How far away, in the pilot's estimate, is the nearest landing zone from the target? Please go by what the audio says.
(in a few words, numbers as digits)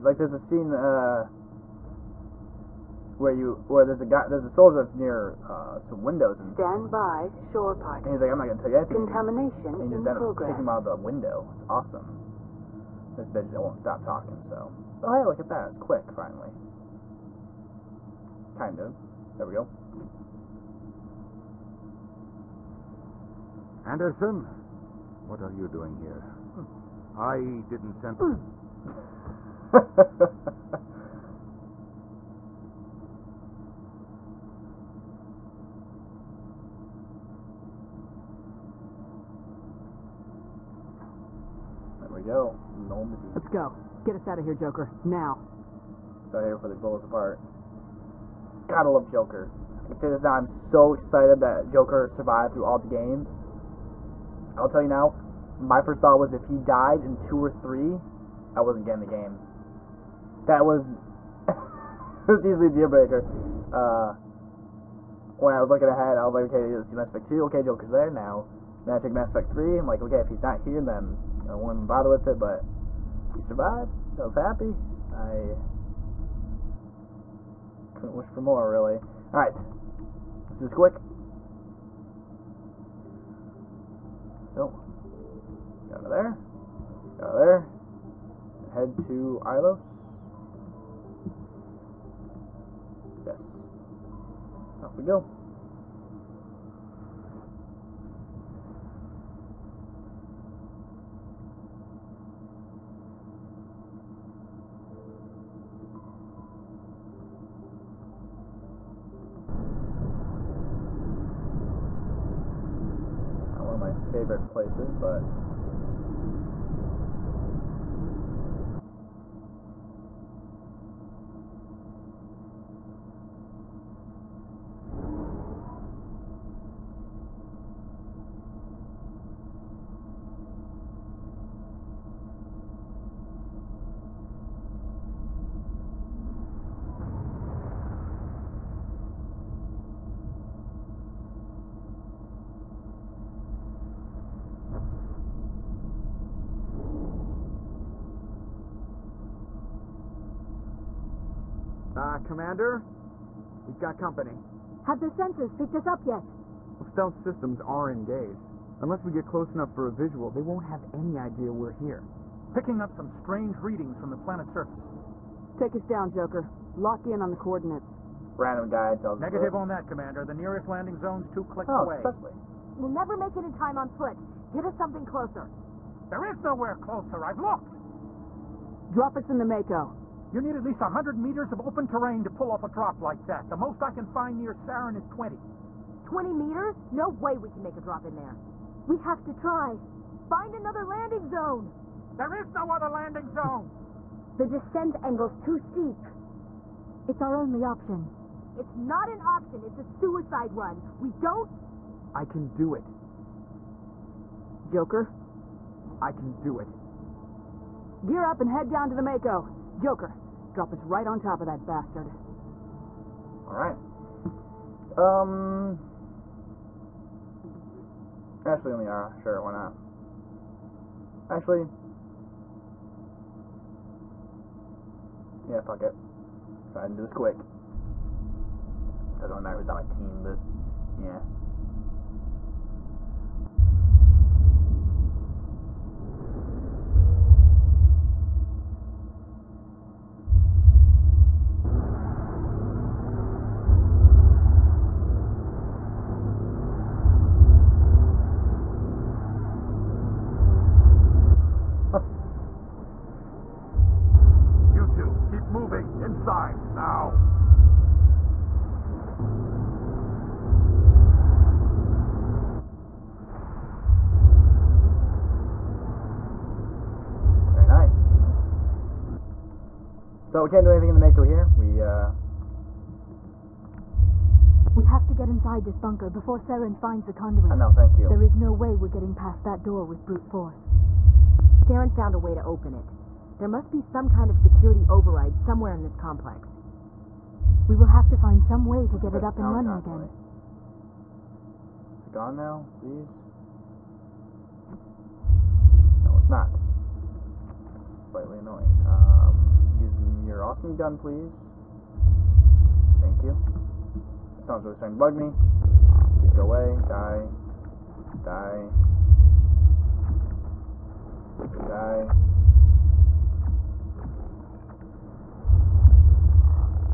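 2 clicks.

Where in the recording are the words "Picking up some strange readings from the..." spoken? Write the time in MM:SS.
02:42.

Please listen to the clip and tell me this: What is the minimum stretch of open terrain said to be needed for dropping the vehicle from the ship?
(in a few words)
100 meters.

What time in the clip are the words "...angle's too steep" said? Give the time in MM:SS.
03:15.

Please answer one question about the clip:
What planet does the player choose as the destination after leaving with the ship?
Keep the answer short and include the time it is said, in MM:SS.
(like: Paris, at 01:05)
Ilos, at 01:29.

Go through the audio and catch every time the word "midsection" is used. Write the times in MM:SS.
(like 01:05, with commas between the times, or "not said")
not said.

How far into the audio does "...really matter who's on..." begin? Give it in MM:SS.
03:49.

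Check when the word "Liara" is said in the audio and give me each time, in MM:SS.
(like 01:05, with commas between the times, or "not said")
03:38.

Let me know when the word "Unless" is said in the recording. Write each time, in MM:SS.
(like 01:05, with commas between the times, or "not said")
02:38.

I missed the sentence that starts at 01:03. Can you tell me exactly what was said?
Uh, when I was looking ahead, I was like, okay, let's see Mass Effect 2.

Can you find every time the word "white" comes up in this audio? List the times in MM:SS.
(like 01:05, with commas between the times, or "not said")
not said.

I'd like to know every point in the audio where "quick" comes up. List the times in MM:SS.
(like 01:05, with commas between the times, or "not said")
00:15, 01:20, 03:47.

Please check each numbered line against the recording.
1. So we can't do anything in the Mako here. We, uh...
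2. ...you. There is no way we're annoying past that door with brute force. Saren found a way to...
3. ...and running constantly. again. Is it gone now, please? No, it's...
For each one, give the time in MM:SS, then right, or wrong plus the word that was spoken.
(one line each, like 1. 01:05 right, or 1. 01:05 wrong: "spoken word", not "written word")
1. 04:30 right
2. 04:37 wrong: "getting", not "annoying"
3. 04:49 right.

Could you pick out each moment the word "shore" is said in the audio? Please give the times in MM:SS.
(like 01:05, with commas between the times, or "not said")
00:07.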